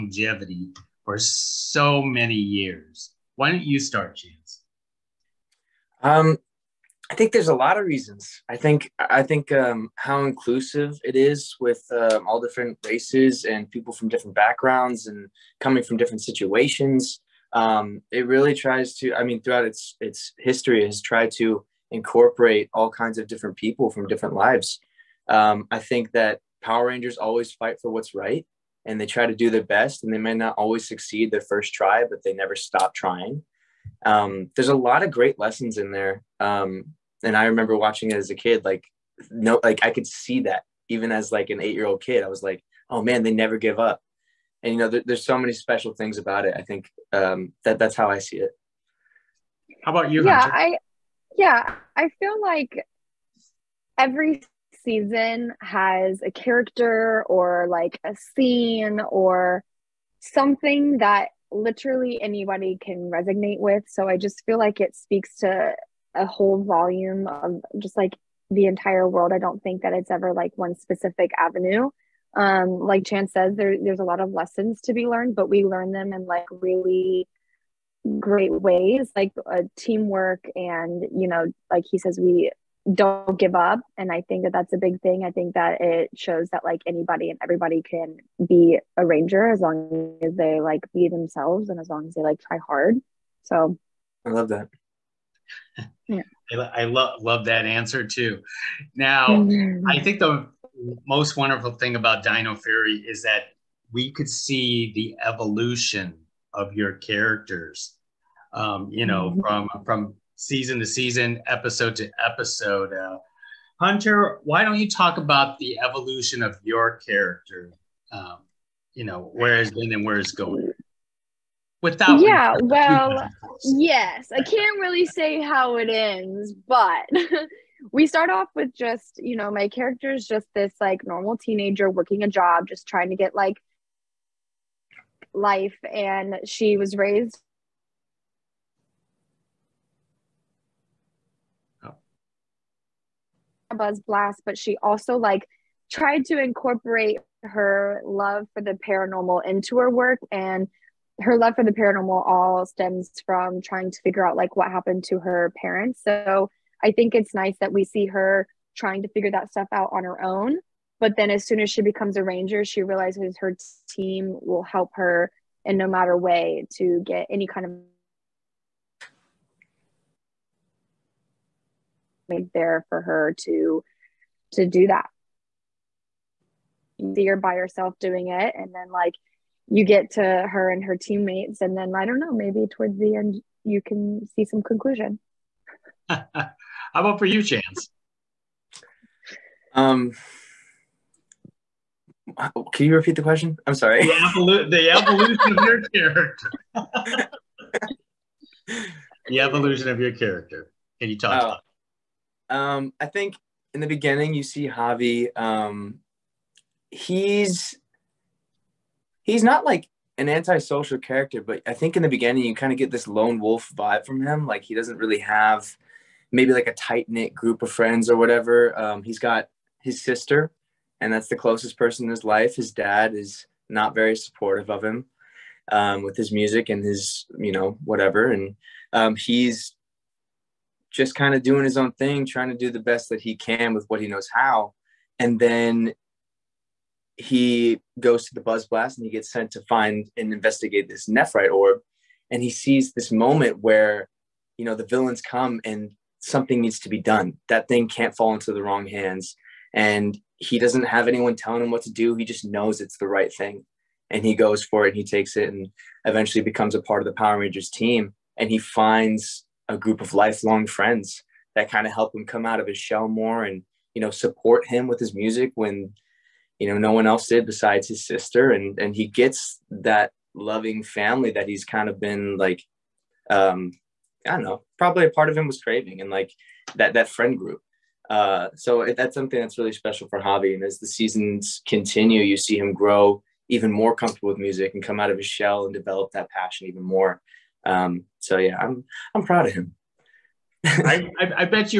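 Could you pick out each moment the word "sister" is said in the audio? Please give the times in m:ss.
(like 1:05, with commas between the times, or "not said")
3:40, 4:28.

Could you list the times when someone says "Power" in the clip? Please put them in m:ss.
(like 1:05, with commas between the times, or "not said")
0:26, 4:17.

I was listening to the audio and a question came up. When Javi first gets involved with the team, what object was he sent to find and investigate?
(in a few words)
Nephrite orb.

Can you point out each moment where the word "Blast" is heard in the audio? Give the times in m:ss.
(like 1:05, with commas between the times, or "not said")
2:23, 3:58.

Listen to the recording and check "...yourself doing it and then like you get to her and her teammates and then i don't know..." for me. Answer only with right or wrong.
right.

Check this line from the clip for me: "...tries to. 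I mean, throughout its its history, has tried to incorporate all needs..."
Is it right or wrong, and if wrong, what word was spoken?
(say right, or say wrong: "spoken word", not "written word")
wrong: "kinds", not "needs".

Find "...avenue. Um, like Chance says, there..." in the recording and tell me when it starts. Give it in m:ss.
1:11.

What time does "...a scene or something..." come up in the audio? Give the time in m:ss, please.
0:58.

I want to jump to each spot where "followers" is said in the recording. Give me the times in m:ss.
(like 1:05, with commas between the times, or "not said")
not said.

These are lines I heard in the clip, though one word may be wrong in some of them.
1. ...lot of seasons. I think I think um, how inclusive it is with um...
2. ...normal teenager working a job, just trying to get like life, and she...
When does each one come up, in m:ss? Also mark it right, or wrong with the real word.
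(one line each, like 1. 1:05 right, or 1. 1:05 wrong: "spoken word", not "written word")
1. 0:07 wrong: "reasons", not "seasons"
2. 2:11 right.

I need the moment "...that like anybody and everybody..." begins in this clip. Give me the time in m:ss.
1:26.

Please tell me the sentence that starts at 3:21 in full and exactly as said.
about um, I think in the beginning you see Javi.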